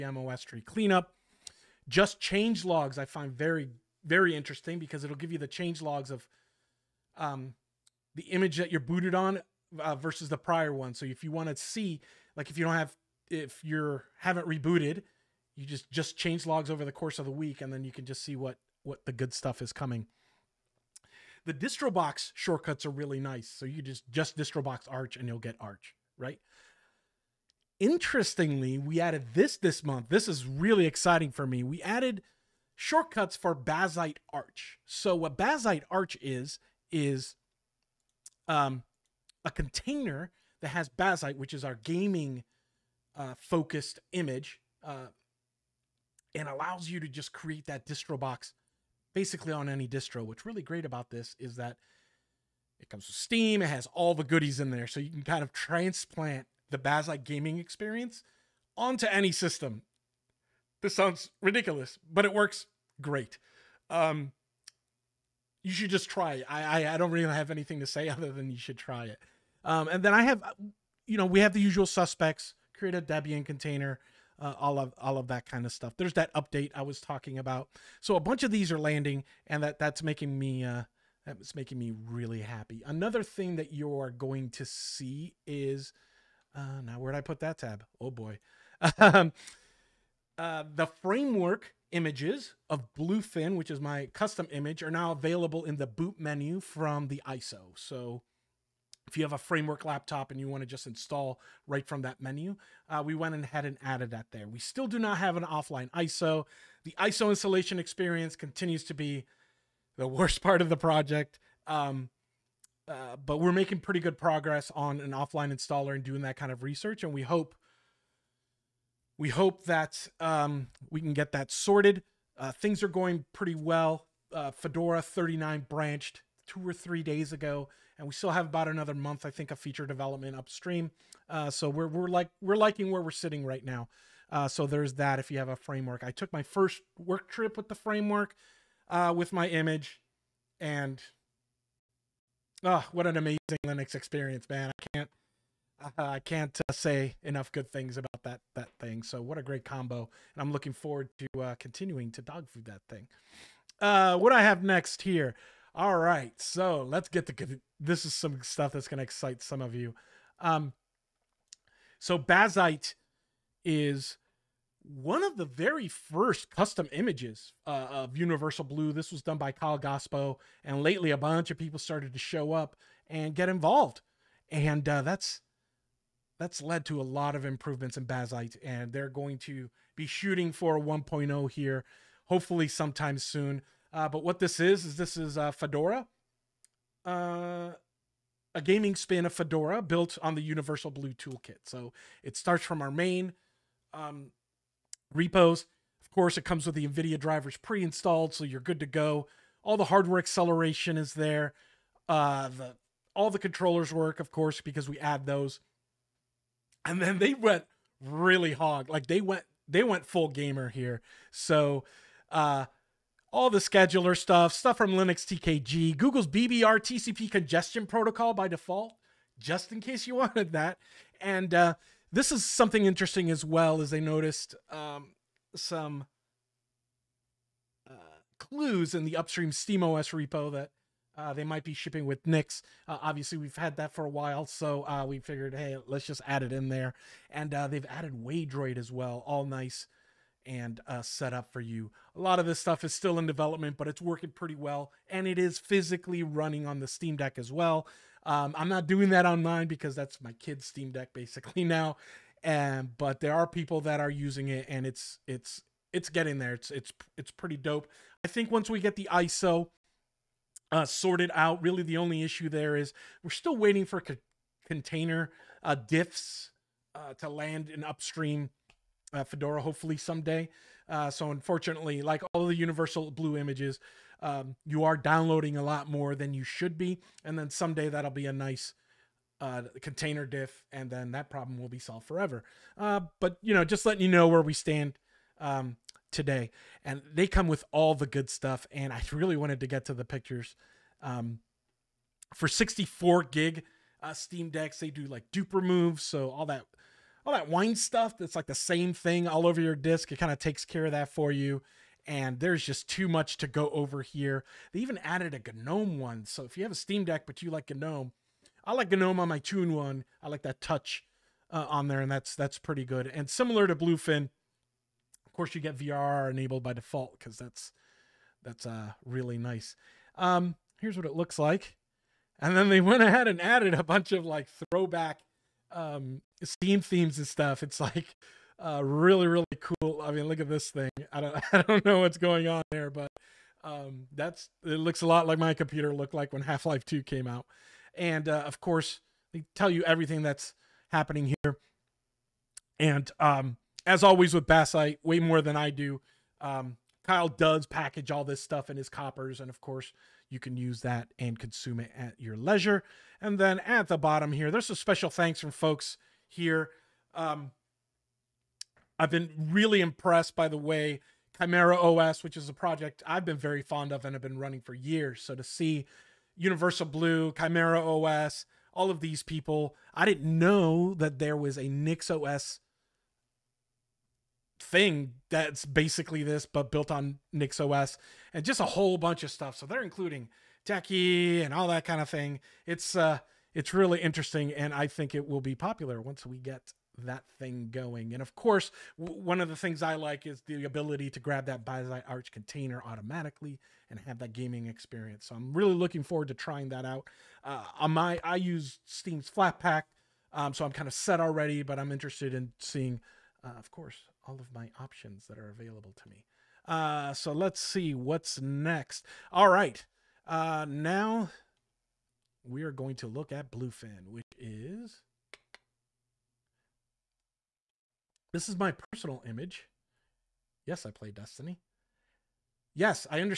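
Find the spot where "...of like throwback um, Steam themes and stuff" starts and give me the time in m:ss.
5:24.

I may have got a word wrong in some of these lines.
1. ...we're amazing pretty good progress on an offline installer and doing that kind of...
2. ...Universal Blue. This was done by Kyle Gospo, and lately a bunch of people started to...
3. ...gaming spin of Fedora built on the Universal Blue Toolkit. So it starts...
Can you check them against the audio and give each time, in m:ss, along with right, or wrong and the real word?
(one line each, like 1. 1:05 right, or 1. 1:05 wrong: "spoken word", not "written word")
1. 1:53 wrong: "making", not "amazing"
2. 2:48 right
3. 3:08 right.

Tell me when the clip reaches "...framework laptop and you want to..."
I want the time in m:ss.
1:39.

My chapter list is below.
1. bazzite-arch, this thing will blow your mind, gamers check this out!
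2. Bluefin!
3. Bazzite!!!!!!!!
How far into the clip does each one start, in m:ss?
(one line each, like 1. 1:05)
1. 0:33
2. 6:52
3. 2:34.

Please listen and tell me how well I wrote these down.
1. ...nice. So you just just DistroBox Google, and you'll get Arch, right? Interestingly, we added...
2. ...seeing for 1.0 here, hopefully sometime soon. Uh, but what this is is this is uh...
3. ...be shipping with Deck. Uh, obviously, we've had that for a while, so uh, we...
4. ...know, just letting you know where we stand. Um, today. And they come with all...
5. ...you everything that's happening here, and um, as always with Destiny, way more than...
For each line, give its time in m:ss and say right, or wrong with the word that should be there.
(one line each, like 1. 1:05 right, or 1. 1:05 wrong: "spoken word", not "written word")
1. 0:23 wrong: "Arch", not "Google"
2. 3:00 wrong: "shooting", not "seeing"
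3. 3:51 wrong: "Nix", not "Deck"
4. 4:43 right
5. 5:39 wrong: "Bazzite", not "Destiny".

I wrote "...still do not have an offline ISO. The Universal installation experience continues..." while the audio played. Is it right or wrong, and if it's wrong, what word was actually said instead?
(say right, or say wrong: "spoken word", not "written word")
wrong: "ISO", not "Universal".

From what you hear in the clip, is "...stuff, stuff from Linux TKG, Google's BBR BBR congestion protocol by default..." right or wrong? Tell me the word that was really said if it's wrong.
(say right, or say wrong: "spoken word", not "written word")
wrong: "TCP", not "BBR".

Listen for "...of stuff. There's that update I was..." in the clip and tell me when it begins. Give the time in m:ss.
1:15.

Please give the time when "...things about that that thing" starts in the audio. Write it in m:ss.
2:27.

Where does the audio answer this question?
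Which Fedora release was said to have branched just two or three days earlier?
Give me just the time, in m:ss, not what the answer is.
2:04.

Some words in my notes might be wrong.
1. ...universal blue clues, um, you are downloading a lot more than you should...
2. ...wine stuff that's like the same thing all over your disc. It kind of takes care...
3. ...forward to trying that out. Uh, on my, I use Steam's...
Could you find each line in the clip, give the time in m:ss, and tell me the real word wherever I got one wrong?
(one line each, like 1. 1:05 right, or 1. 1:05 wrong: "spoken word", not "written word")
1. 4:32 wrong: "images", not "clues"
2. 4:57 right
3. 6:36 right.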